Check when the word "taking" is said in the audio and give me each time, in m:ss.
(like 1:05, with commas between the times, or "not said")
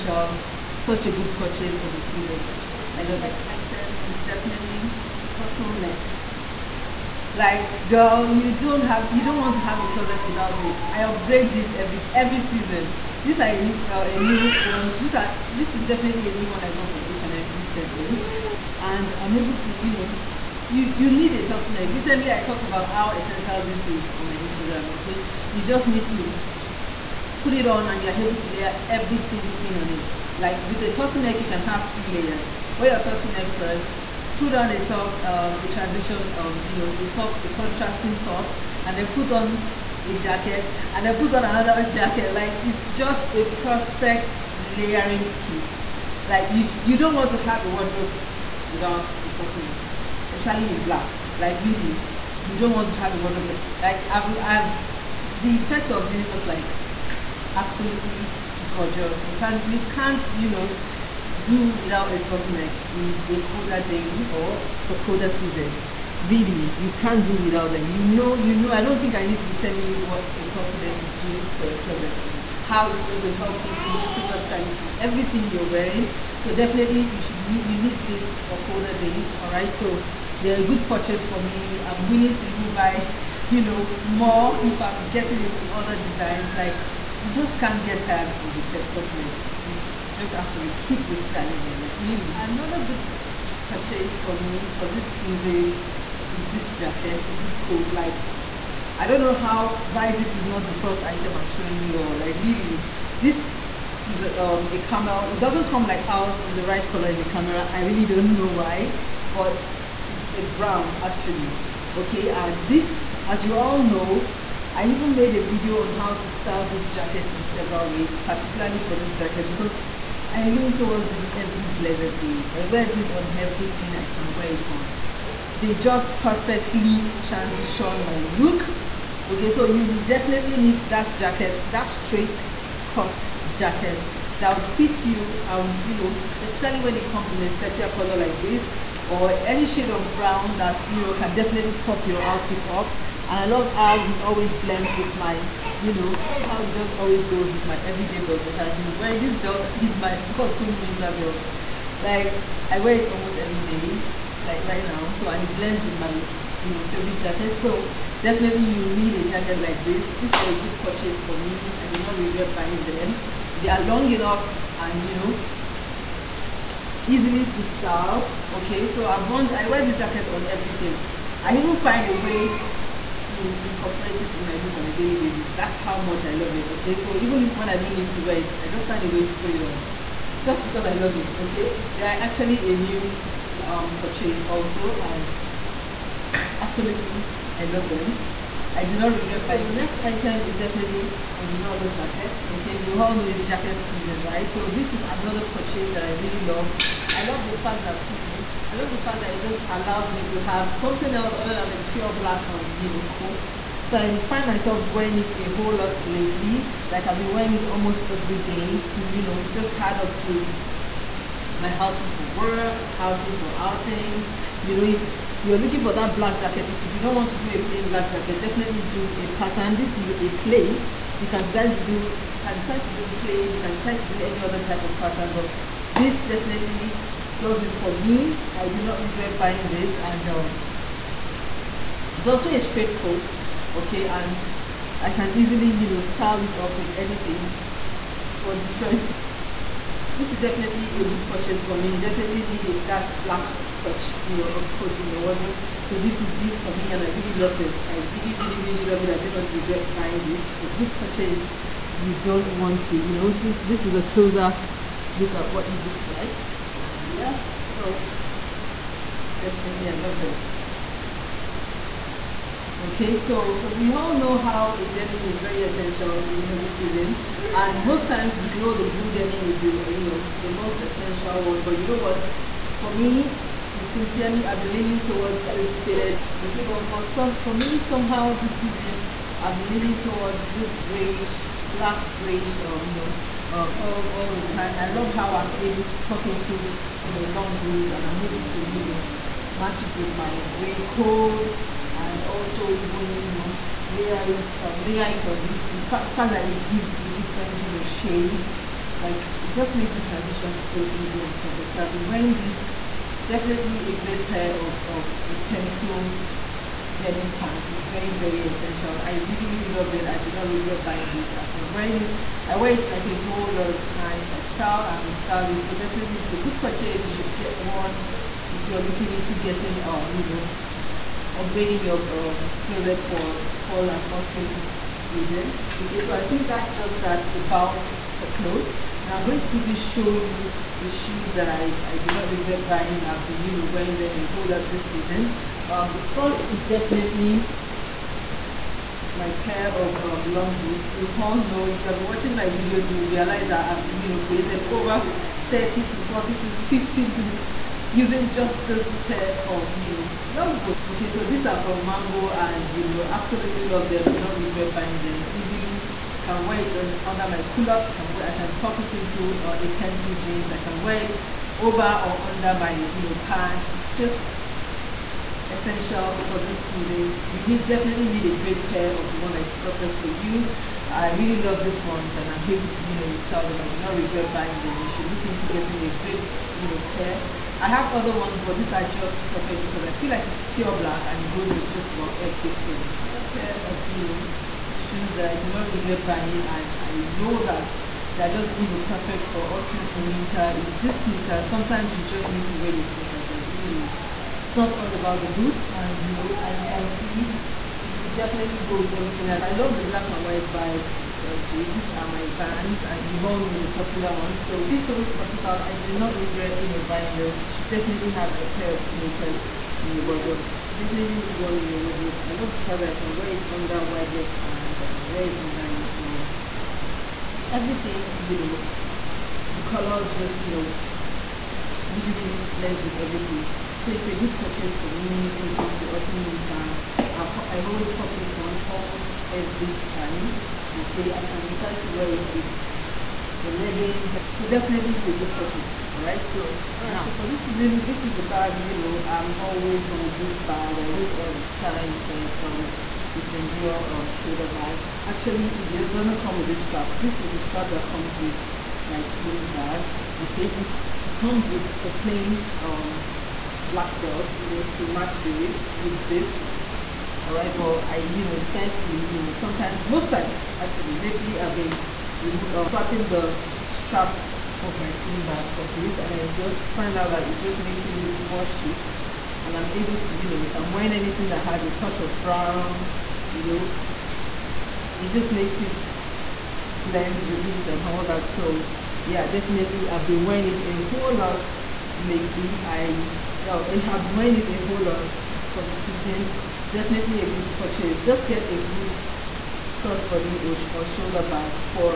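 not said.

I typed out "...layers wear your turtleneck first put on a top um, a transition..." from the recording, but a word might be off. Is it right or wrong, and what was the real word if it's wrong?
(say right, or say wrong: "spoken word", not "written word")
right.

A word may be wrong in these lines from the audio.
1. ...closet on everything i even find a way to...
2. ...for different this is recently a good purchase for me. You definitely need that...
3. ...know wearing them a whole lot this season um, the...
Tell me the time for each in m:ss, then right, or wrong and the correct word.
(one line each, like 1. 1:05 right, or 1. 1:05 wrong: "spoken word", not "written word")
1. 2:49 wrong: "jacket", not "closet"
2. 3:58 wrong: "definitely", not "recently"
3. 5:33 right.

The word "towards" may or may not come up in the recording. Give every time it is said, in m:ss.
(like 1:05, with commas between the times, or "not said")
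2:00, 4:35, 4:39.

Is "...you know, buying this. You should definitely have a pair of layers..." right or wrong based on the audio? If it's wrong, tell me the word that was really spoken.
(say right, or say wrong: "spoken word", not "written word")
wrong: "sneakers", not "layers".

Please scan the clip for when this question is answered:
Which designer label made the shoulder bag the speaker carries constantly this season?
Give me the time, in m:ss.
7:23.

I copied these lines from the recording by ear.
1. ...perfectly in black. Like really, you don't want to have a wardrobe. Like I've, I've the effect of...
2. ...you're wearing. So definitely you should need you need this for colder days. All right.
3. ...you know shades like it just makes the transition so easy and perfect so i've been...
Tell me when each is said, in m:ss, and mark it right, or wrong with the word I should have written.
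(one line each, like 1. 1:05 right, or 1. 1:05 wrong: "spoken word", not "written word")
1. 0:50 wrong: "especially", not "perfectly"
2. 1:15 right
3. 4:57 right.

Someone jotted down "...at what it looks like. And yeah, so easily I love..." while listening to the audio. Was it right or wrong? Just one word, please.
wrong.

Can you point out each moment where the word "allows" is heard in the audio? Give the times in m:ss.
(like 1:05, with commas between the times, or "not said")
3:19.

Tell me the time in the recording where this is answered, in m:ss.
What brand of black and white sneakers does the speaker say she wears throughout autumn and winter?
6:42.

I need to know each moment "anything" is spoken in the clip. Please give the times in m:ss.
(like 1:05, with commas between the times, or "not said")
3:56, 7:50.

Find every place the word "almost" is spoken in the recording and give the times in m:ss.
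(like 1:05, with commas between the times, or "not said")
2:33, 3:27, 7:08.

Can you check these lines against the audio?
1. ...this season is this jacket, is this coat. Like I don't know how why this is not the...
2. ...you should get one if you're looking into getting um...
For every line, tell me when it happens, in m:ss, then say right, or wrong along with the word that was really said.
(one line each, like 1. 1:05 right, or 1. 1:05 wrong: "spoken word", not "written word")
1. 1:34 right
2. 5:17 right.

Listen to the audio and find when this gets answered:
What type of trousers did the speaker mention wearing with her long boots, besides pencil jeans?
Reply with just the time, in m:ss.
5:57.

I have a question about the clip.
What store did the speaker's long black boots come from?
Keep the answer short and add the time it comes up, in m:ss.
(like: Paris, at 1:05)
Mango, at 5:51.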